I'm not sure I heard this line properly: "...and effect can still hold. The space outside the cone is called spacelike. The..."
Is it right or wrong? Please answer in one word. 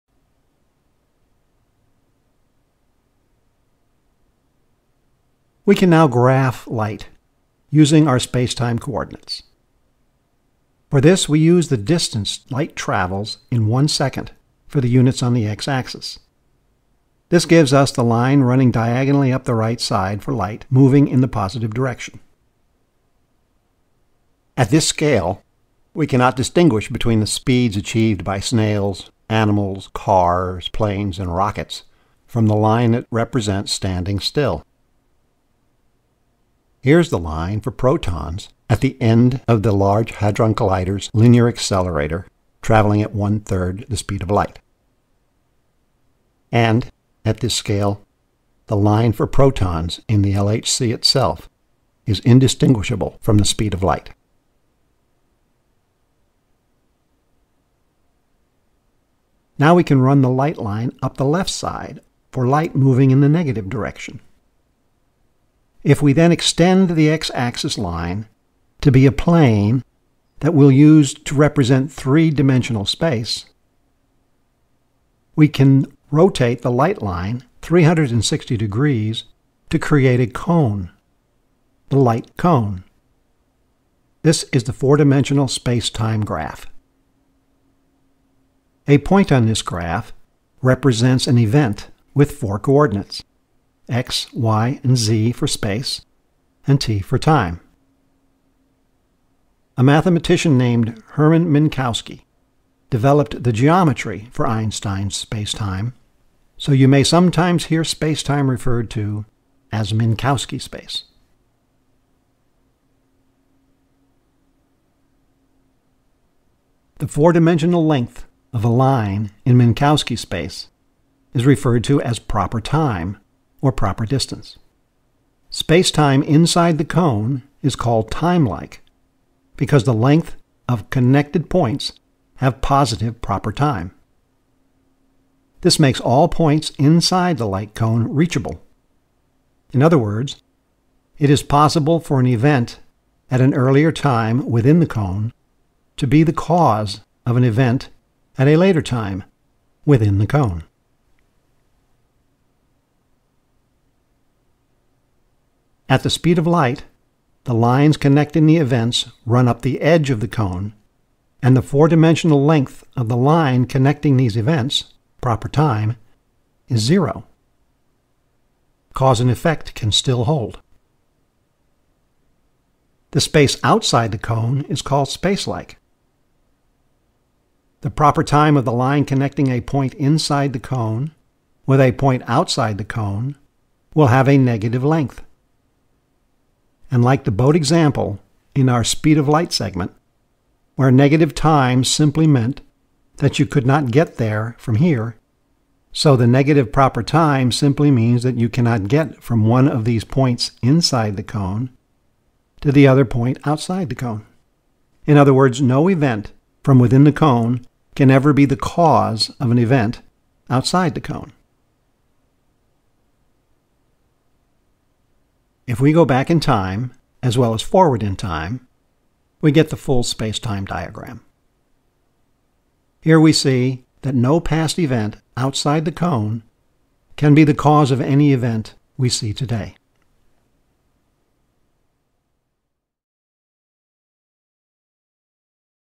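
right.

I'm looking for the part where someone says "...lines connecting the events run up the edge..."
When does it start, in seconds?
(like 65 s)
157 s.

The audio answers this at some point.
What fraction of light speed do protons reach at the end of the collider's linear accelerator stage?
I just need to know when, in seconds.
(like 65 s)
43 s.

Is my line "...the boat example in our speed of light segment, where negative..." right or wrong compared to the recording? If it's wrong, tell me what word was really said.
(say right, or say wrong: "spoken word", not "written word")
right.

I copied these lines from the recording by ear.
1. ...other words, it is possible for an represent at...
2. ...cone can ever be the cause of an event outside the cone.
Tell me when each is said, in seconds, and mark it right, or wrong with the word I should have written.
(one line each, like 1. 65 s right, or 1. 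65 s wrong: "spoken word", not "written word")
1. 139 s wrong: "event", not "represent"
2. 207 s right.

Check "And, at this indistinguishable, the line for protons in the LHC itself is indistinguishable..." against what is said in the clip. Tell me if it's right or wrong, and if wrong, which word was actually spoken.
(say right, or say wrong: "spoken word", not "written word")
wrong: "scale", not "indistinguishable".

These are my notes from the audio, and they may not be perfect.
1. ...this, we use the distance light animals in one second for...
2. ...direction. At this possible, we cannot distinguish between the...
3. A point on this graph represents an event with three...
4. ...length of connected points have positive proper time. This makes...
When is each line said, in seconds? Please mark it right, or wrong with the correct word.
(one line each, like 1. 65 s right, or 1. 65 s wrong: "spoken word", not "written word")
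1. 10 s wrong: "travels", not "animals"
2. 21 s wrong: "scale", not "possible"
3. 88 s wrong: "four", not "three"
4. 129 s right.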